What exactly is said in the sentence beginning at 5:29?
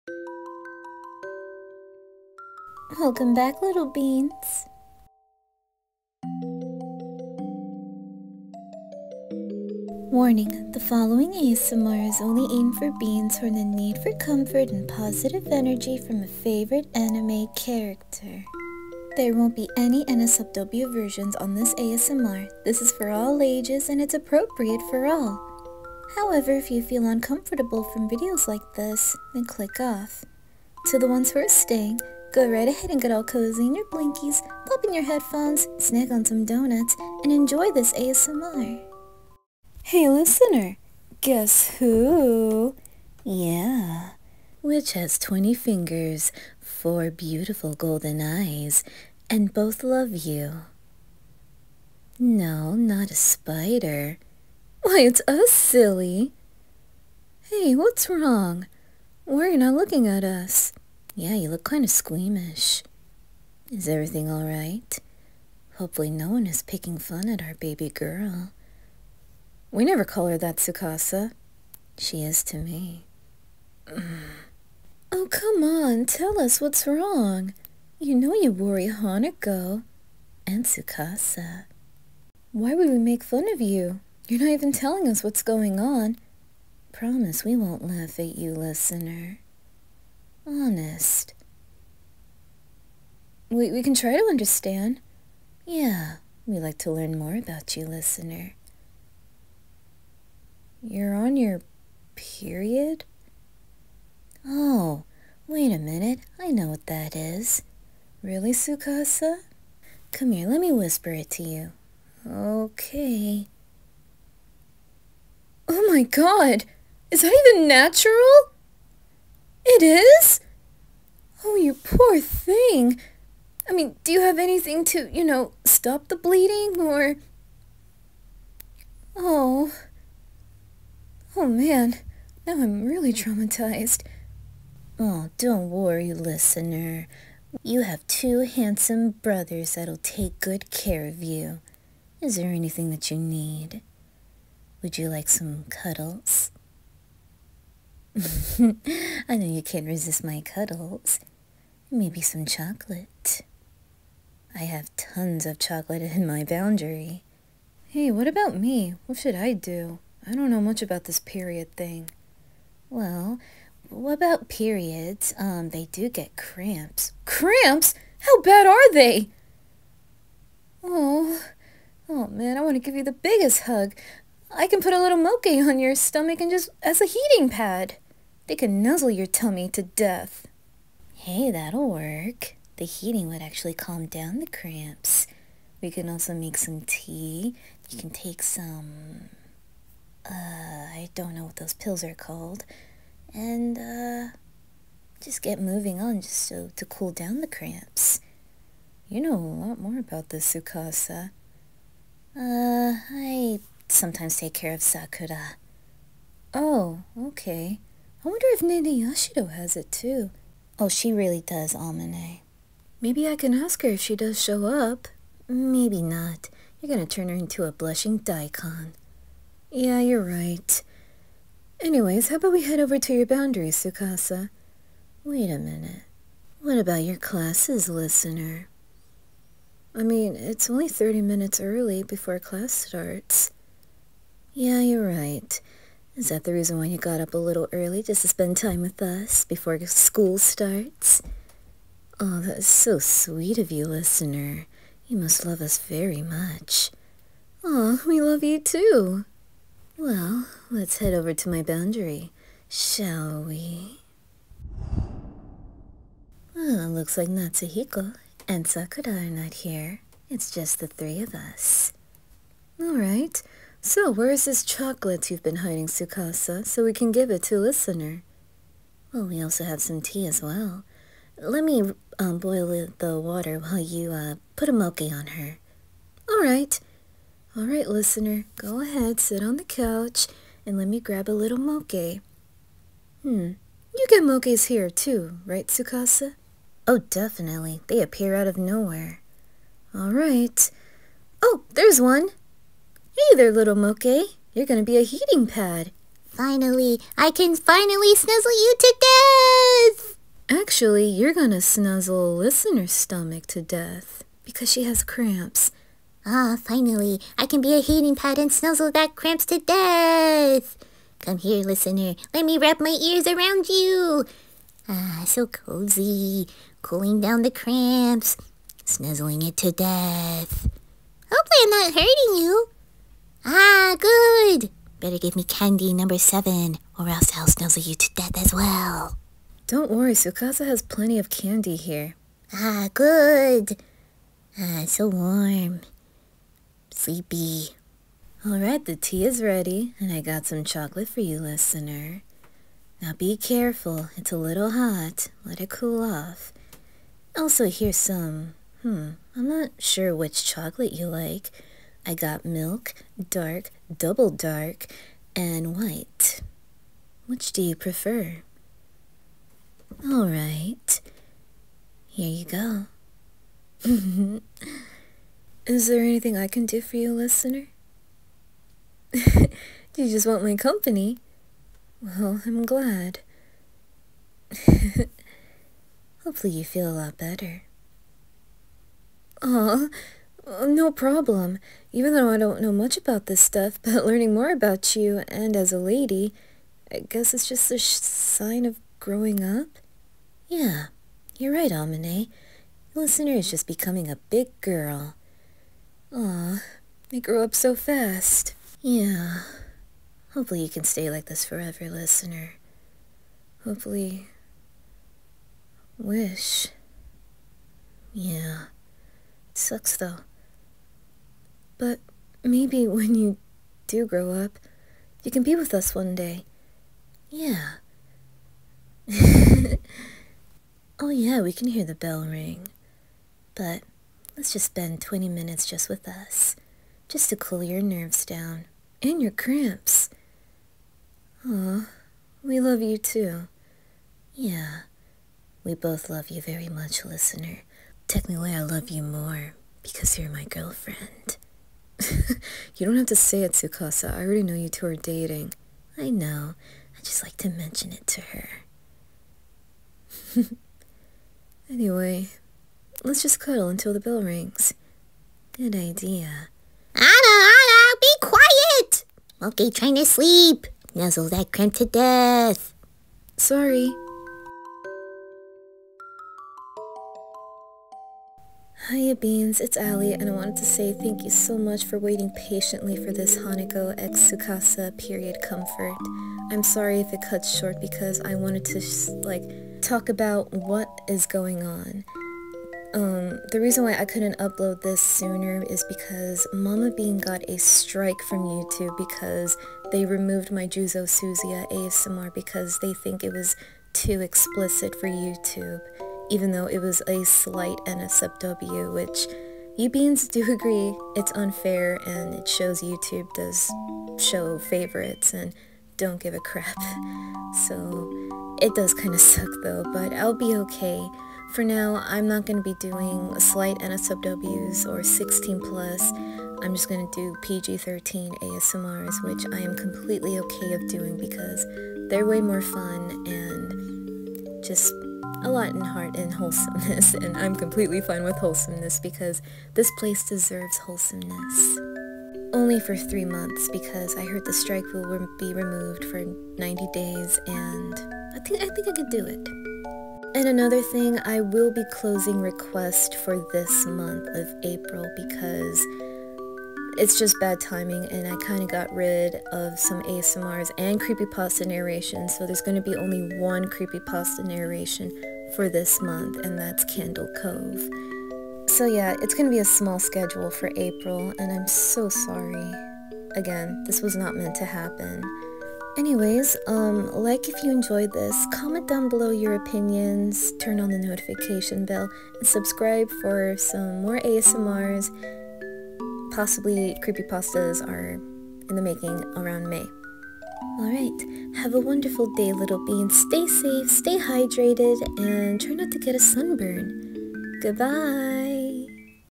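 Don't worry, Tsukasa has plenty of candy here.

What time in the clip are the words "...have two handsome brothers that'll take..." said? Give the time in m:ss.
2:17.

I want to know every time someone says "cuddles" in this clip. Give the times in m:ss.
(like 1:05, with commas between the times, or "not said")
2:25, 2:30, 7:33.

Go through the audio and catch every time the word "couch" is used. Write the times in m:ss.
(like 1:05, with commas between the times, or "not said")
4:39.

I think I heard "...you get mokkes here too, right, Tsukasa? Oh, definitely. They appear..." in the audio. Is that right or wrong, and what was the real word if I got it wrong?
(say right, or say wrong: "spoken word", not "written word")
right.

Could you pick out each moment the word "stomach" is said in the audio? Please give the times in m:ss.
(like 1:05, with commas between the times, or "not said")
2:55, 5:02.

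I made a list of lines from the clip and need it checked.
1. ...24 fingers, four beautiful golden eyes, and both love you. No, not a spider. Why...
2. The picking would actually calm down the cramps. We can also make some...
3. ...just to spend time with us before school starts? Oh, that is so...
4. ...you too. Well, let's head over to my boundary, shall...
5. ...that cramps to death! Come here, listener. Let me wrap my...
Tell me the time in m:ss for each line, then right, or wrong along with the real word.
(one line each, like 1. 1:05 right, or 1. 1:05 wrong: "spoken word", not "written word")
1. 0:45 wrong: "20", not "24"
2. 3:02 wrong: "heating", not "picking"
3. 3:58 right
4. 4:08 right
5. 5:08 right.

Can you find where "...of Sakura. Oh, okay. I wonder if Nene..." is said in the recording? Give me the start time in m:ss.
3:24.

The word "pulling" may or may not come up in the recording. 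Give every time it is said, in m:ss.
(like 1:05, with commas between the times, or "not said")
not said.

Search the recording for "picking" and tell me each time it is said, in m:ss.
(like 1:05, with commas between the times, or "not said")
1:06.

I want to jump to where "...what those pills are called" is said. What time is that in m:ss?
3:11.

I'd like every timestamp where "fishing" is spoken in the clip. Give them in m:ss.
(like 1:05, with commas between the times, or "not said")
not said.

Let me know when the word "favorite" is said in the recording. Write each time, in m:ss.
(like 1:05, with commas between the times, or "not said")
0:16, 8:24.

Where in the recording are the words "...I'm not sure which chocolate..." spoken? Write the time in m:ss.
5:49.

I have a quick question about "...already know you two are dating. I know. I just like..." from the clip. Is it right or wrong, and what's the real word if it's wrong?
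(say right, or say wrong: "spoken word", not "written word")
right.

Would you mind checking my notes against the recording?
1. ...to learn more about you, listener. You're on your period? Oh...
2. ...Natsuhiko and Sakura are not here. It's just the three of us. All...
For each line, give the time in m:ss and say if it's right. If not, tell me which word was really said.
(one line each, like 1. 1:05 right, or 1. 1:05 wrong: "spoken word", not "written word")
1. 1:36 right
2. 4:17 right.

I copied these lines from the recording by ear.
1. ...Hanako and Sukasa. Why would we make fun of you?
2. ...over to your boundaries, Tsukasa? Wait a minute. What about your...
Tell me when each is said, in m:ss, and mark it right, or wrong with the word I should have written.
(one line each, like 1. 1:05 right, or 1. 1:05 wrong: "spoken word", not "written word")
1. 1:18 right
2. 3:42 right.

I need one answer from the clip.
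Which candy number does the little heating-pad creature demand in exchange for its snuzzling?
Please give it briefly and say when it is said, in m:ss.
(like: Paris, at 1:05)
7, at 5:26.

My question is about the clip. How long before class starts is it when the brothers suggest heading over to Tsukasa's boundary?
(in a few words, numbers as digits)
30 minutes.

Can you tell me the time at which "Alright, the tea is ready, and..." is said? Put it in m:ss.
5:38.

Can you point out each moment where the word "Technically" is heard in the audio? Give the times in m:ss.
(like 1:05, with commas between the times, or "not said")
7:18.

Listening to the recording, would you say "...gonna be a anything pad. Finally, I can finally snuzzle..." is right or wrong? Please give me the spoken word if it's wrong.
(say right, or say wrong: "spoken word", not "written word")
wrong: "heating", not "anything".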